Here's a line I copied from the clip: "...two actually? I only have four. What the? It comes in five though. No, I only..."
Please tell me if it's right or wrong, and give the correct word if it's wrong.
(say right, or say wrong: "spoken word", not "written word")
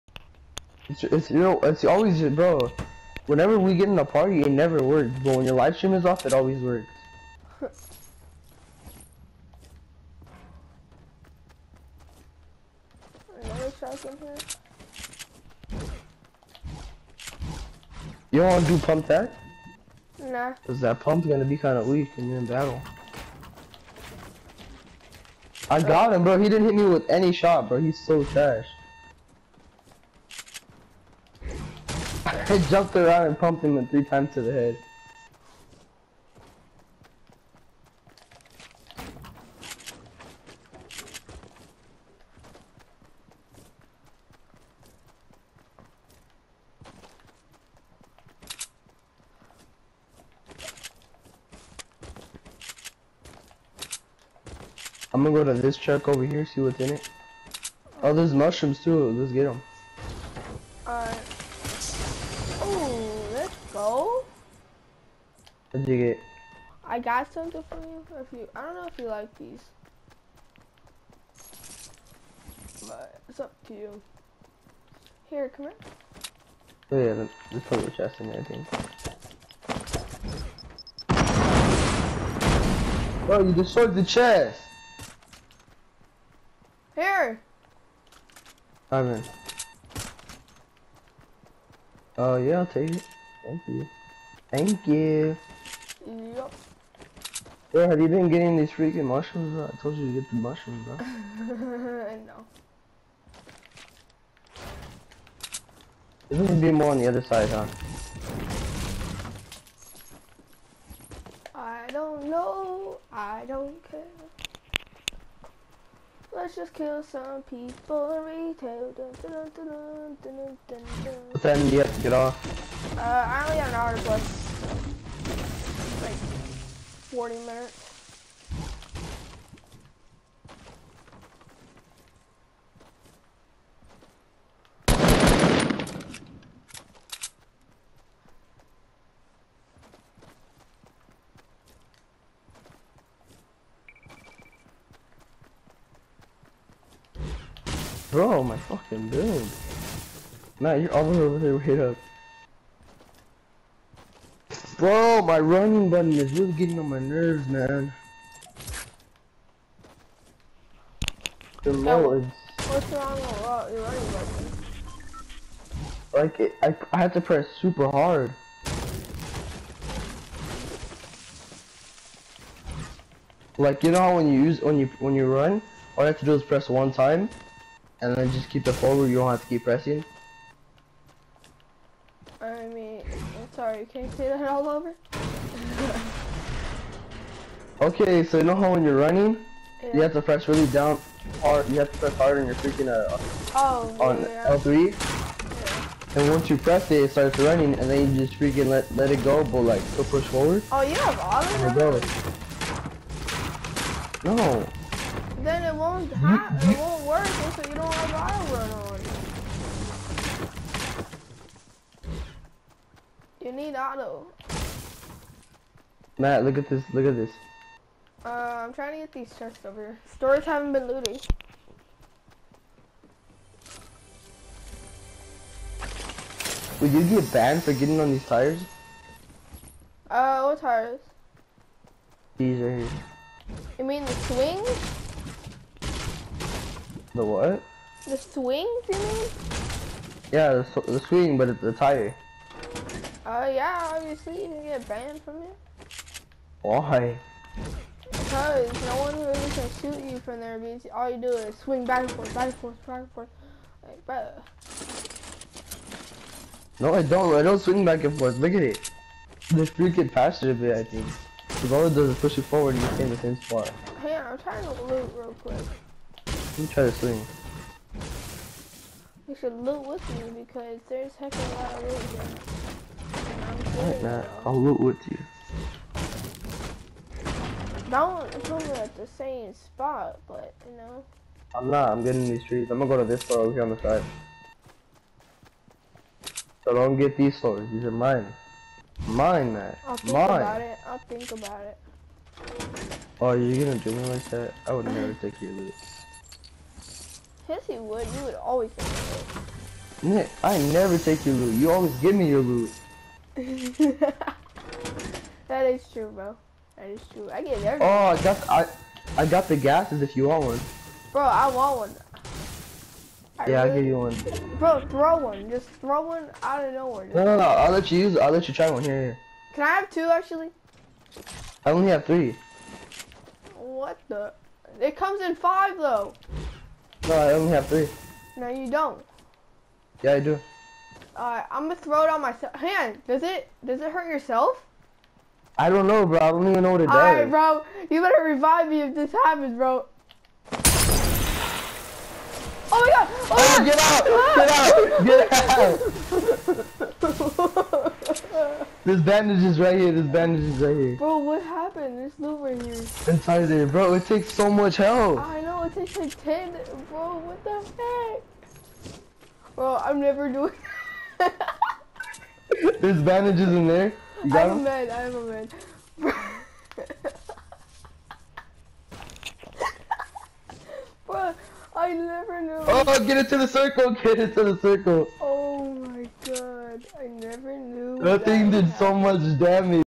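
wrong: "three", not "four".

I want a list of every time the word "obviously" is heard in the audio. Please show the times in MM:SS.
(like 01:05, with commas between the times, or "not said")
04:03.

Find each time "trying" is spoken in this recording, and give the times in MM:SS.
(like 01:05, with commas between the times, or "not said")
03:38, 04:24.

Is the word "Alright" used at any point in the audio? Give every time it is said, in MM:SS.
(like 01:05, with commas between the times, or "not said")
01:00, 05:31, 05:37.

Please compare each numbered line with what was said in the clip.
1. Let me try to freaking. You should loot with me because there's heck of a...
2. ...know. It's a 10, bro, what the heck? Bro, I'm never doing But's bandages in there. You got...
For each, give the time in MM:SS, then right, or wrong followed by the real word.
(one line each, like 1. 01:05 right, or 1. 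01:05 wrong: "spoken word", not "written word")
1. 04:26 wrong: "swing", not "freaking"
2. 05:55 wrong: "There", not "But".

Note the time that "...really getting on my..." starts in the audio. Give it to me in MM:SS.
02:36.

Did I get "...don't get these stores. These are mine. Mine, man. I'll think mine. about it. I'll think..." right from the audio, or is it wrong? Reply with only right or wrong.
right.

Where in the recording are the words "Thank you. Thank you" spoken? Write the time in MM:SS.
01:33.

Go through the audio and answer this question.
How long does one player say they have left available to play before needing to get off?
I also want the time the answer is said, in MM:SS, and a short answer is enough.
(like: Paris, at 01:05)
40 minutes, at 02:07.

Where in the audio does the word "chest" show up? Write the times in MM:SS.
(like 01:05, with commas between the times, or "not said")
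01:17, 01:24, 03:39.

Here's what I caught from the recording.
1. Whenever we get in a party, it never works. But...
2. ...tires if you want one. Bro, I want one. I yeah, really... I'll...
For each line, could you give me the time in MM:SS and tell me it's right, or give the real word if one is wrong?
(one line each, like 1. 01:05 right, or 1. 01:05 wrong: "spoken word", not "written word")
1. 00:03 right
2. 05:09 wrong: "gases", not "tires".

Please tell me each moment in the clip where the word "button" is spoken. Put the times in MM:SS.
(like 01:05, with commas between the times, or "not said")
02:35, 02:44.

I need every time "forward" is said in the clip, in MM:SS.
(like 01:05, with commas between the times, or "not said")
02:58, 03:20, 04:22.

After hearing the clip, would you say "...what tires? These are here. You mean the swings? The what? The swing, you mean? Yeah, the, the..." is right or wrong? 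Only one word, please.
right.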